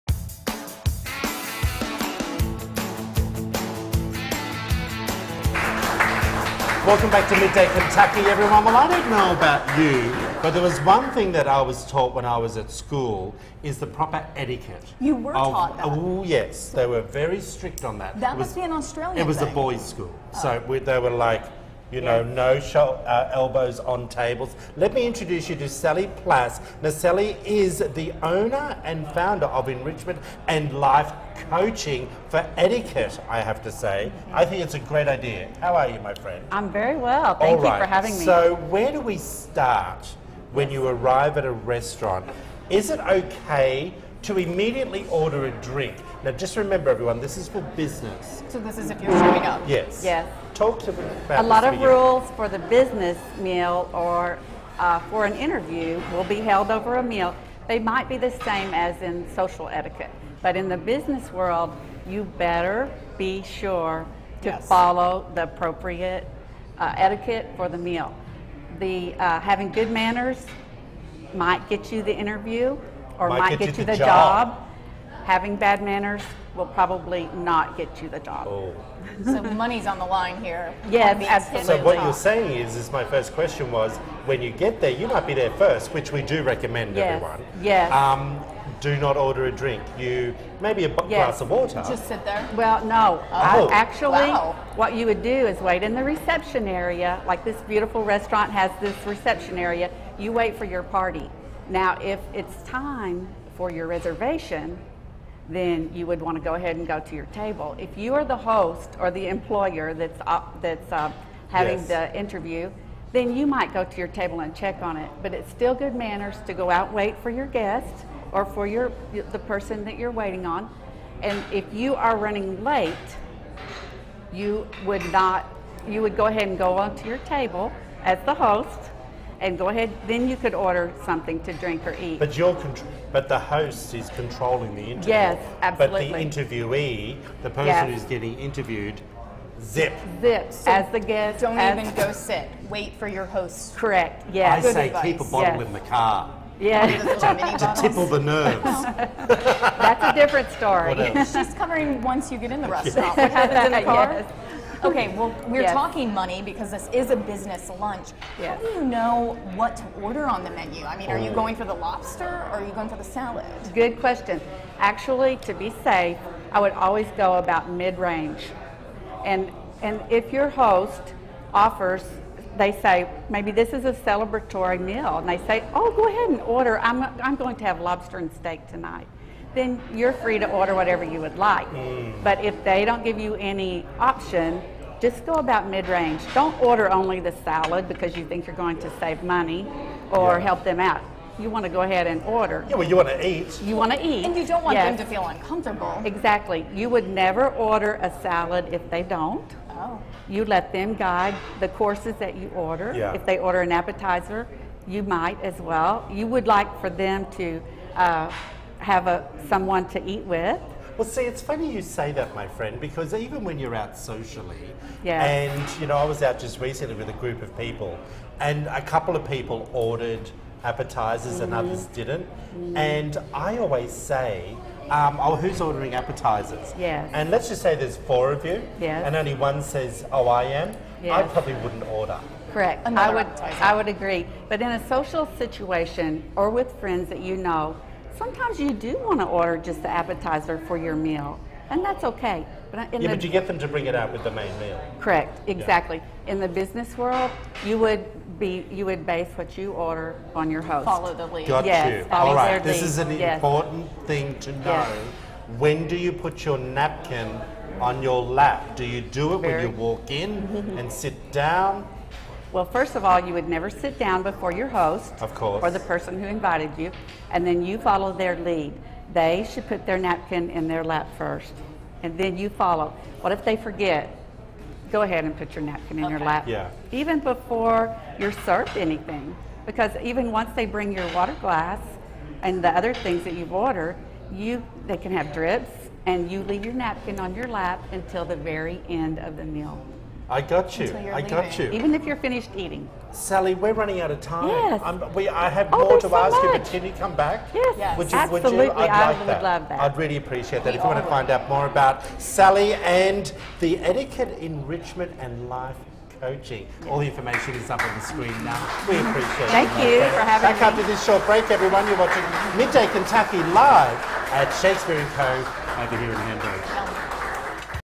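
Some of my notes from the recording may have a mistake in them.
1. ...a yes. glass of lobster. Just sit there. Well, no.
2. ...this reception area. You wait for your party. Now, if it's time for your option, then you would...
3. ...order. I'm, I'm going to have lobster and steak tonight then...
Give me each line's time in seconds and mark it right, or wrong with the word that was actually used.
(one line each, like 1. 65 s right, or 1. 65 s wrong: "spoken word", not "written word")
1. 90 s wrong: "water", not "lobster"
2. 98 s wrong: "reservation", not "option"
3. 176 s right.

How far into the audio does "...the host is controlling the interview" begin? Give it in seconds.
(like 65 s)
133 s.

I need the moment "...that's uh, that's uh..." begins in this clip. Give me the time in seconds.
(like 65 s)
109 s.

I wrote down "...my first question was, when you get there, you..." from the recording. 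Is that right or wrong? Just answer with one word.
right.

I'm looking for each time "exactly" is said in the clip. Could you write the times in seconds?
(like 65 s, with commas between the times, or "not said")
196 s, 245 s.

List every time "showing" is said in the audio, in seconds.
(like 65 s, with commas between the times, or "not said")
49 s.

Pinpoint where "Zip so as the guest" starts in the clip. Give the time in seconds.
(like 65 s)
140 s.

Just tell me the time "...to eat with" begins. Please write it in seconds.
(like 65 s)
209 s.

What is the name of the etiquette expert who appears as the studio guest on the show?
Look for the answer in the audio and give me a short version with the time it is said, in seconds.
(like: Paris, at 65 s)
Sallie Plass, at 25 s.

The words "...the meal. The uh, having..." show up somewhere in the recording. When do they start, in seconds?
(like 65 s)
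67 s.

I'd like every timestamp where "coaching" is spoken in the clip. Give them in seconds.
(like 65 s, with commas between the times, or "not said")
31 s, 306 s.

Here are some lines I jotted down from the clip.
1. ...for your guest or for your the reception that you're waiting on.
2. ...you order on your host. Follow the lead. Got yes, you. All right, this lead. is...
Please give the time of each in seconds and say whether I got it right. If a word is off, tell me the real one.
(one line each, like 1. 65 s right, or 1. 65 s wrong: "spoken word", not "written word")
1. 117 s wrong: "person", not "reception"
2. 249 s right.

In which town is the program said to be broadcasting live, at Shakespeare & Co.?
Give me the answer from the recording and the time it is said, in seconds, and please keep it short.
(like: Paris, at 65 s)
Hamburg, at 316 s.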